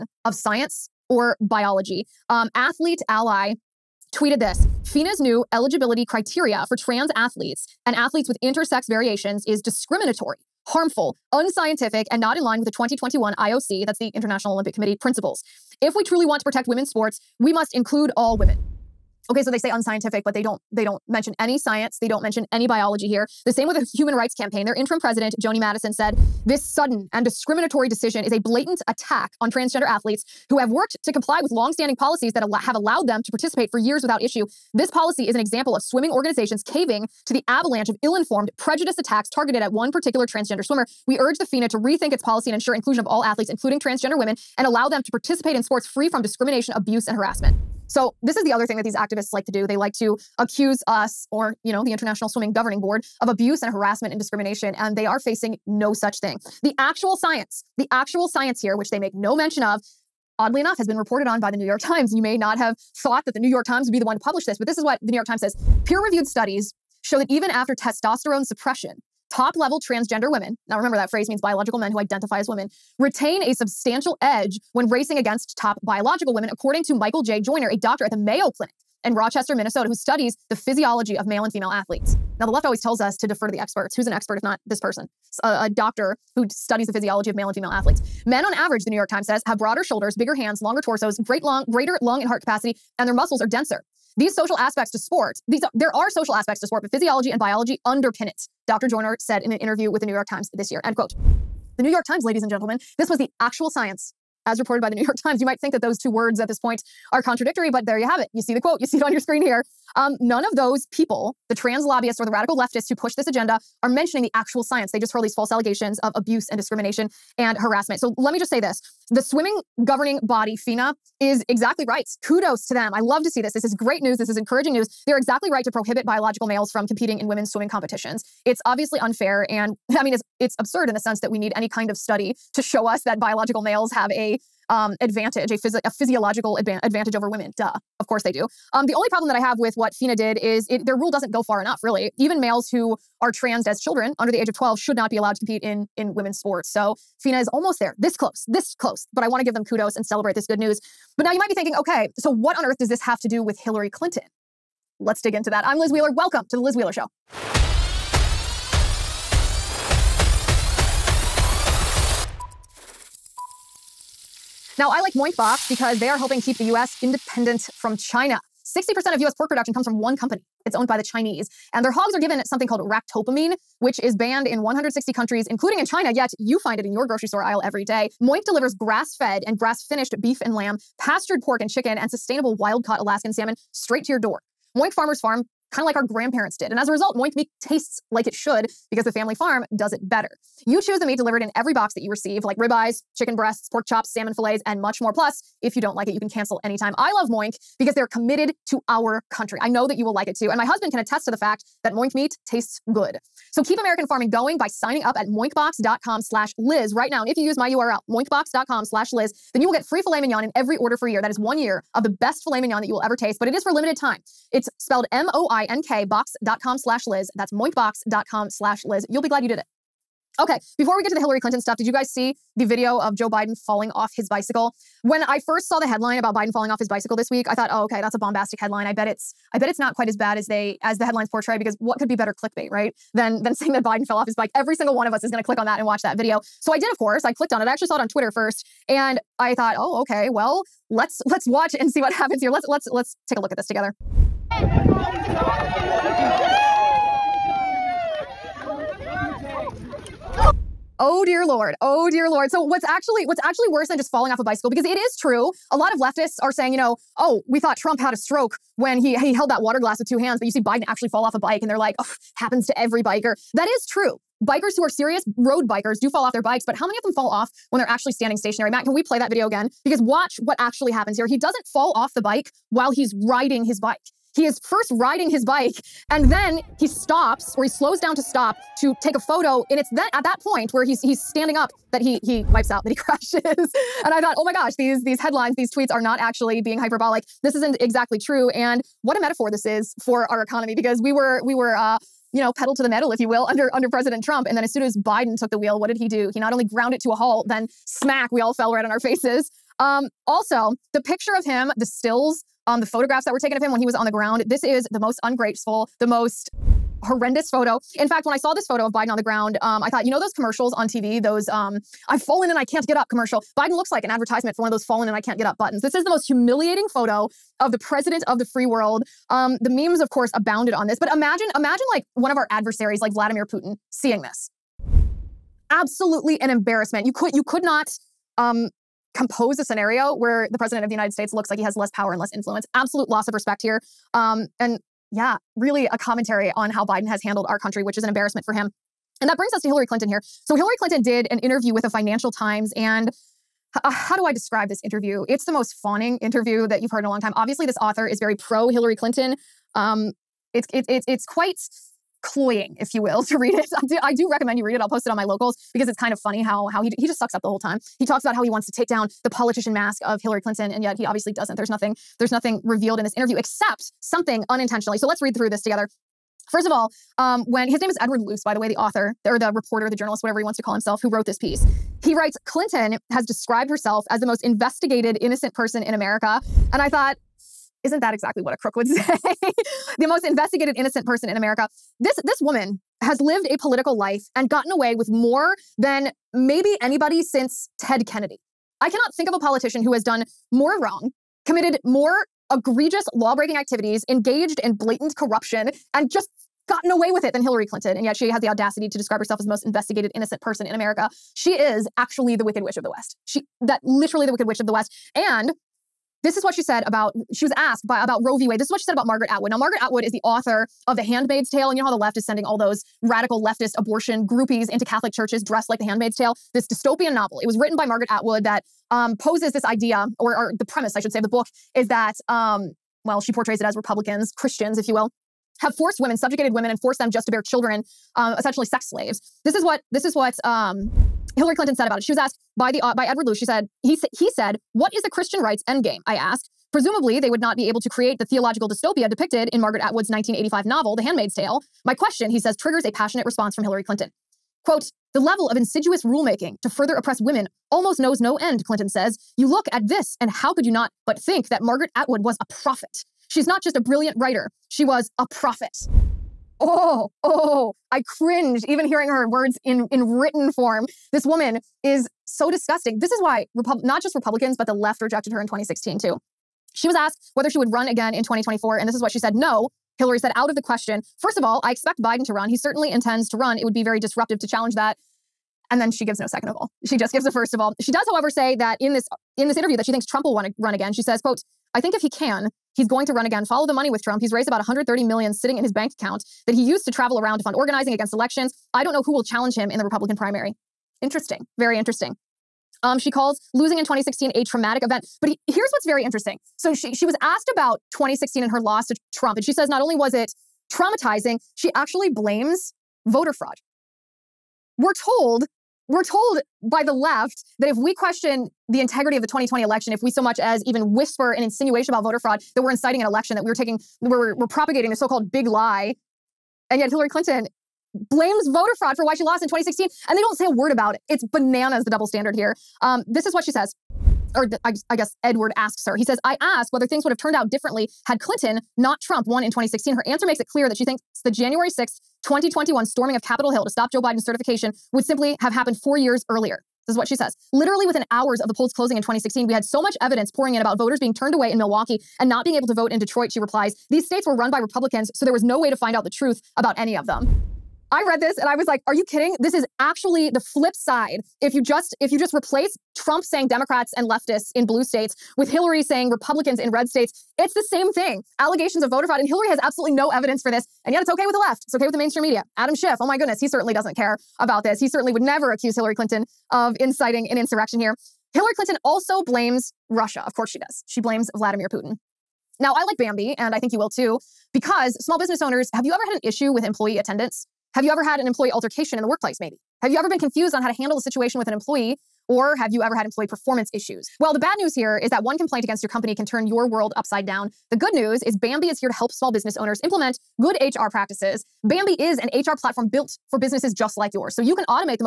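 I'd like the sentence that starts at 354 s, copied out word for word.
I'll post it on my locals because it's kind of funny how how he he just sucks up the whole time.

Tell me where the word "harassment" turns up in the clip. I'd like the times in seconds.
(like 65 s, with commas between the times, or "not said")
47 s, 53 s, 117 s.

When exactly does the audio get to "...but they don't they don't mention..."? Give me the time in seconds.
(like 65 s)
20 s.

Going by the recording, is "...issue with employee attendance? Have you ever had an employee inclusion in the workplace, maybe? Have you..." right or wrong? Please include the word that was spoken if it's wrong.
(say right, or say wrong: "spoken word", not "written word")
wrong: "altercation", not "inclusion".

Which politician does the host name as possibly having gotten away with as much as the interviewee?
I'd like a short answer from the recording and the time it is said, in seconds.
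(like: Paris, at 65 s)
Ted Kennedy, at 387 s.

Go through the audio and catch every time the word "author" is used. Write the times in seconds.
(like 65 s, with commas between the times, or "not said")
347 s, 368 s, 410 s.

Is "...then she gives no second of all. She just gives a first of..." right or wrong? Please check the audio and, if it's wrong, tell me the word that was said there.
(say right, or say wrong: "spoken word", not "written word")
right.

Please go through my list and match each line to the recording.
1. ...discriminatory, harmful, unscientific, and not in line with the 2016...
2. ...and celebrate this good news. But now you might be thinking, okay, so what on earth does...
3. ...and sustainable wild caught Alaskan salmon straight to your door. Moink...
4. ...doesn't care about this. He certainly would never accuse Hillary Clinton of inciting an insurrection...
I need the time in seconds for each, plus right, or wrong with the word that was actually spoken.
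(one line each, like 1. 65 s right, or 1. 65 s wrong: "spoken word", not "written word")
1. 9 s wrong: "2021", not "2016"
2. 149 s right
3. 181 s right
4. 563 s right.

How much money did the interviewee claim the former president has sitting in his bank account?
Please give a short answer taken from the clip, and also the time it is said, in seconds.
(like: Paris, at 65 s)
130 million, at 484 s.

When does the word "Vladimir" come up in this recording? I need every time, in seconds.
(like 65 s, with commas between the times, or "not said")
323 s, 571 s.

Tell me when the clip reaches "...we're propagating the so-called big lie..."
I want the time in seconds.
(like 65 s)
514 s.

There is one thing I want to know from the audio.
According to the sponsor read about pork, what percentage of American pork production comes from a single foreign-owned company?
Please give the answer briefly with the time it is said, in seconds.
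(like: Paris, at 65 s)
60%, at 168 s.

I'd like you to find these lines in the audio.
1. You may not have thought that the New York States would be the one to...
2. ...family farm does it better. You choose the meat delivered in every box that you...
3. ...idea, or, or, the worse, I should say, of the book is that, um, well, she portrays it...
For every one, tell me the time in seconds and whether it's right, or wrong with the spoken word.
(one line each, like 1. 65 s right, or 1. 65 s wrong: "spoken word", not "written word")
1. 62 s wrong: "Times", not "States"
2. 189 s right
3. 419 s wrong: "premise", not "worse".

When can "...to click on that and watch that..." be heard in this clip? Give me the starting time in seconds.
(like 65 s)
235 s.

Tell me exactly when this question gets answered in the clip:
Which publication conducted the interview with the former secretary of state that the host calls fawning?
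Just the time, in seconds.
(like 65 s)
341 s.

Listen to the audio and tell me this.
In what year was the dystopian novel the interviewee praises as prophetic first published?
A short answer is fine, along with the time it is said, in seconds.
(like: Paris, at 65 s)
1985, at 440 s.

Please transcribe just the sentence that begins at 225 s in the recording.
When I first saw the headline about Biden falling off his bicycle this week, I thought, "Oh, okay, that's a bombastic headline.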